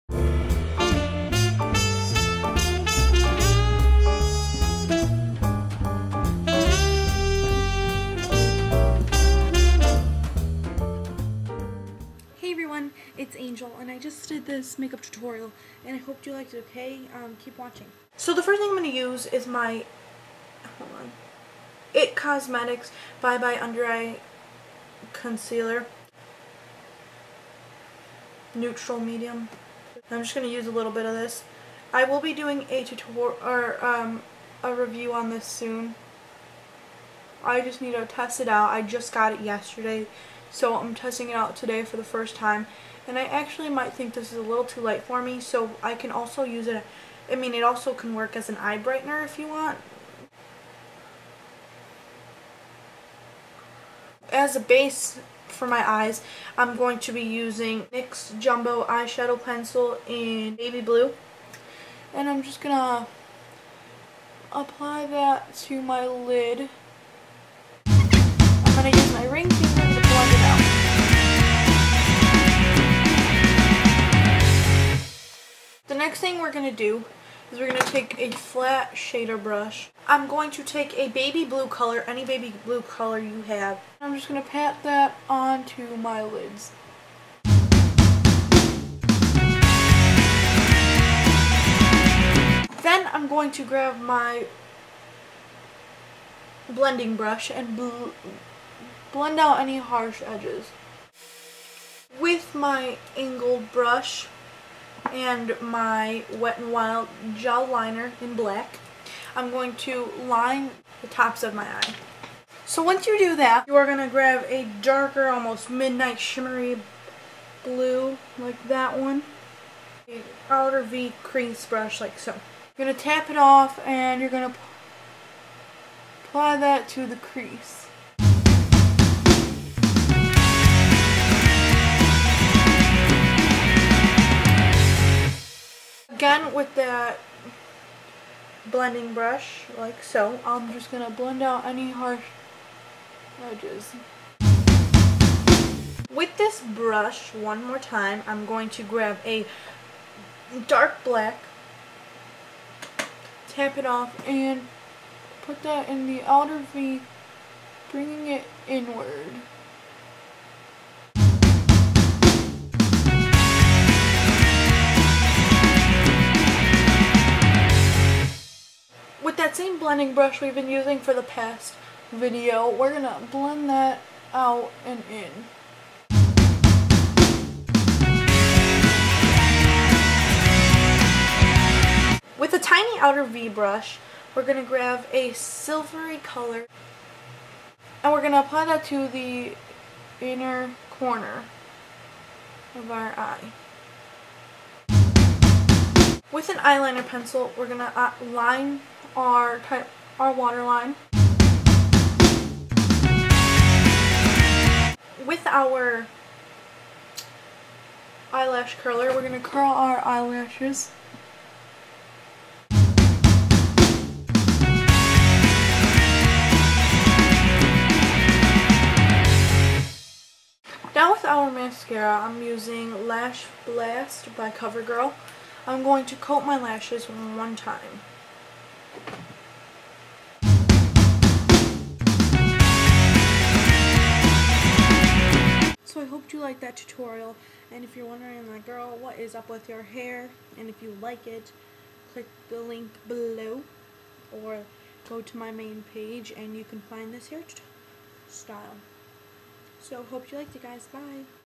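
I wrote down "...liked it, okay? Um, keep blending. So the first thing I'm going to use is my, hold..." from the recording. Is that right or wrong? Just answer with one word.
wrong.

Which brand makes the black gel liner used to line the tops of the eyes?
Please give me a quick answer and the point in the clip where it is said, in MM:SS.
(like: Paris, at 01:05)
Wet n Wild, at 01:46.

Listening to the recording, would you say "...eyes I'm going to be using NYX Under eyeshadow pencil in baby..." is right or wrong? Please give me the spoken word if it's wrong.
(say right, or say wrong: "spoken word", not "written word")
wrong: "Jumbo", not "Under".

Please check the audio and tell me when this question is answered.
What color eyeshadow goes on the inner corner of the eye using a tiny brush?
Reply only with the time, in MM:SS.
03:05.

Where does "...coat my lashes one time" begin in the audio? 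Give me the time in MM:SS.
03:46.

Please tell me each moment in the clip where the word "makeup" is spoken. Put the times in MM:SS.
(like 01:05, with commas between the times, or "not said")
00:14.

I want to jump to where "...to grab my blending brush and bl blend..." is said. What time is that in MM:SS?
01:33.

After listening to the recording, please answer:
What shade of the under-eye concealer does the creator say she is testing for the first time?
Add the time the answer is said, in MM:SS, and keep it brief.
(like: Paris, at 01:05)
Neutral medium, at 00:28.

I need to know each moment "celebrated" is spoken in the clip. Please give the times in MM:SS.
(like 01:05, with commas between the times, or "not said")
not said.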